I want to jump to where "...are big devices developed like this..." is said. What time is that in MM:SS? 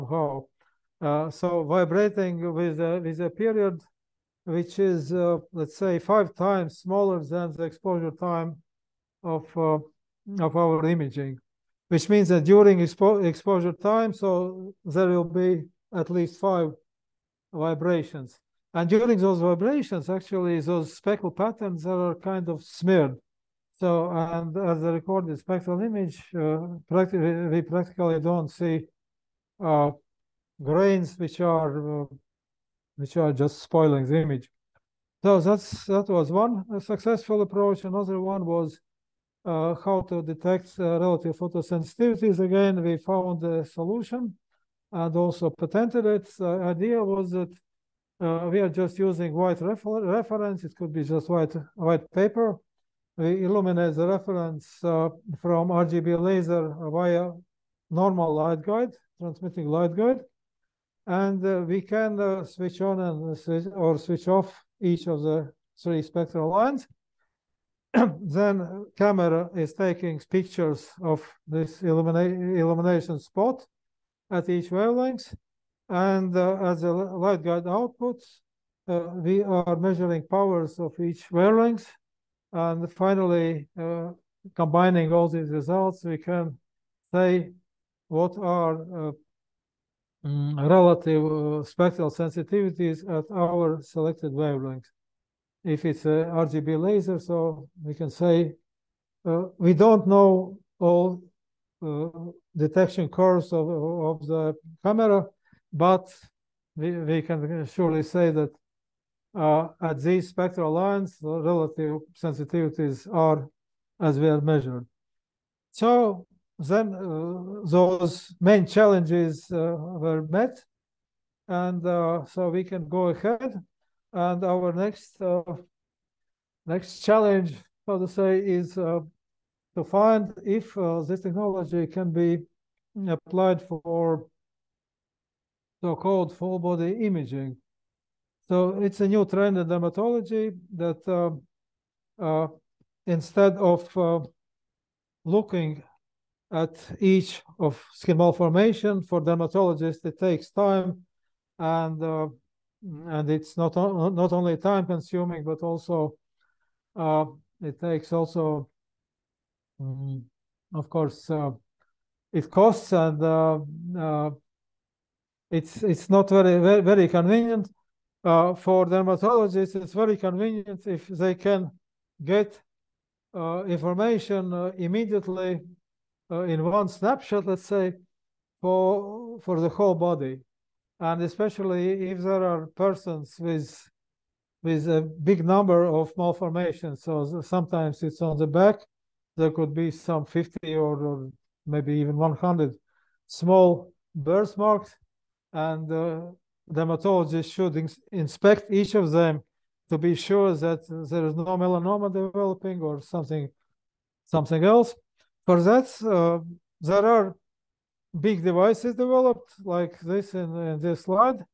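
03:27.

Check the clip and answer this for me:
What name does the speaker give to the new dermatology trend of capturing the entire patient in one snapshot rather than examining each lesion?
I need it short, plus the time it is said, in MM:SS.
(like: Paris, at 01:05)
Full body imaging, at 02:16.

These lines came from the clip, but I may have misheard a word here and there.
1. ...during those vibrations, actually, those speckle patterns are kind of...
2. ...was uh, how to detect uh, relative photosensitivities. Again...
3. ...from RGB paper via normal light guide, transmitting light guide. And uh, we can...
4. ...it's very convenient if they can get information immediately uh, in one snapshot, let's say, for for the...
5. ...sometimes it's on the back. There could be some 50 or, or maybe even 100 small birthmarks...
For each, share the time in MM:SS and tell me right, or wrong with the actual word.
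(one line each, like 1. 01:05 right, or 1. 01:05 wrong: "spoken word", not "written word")
1. 00:18 right
2. 00:38 right
3. 00:55 wrong: "laser", not "paper"
4. 02:49 right
5. 03:07 right.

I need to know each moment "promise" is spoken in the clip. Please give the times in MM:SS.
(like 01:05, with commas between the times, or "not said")
not said.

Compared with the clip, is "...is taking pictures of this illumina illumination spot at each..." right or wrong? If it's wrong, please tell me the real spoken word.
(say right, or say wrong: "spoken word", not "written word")
right.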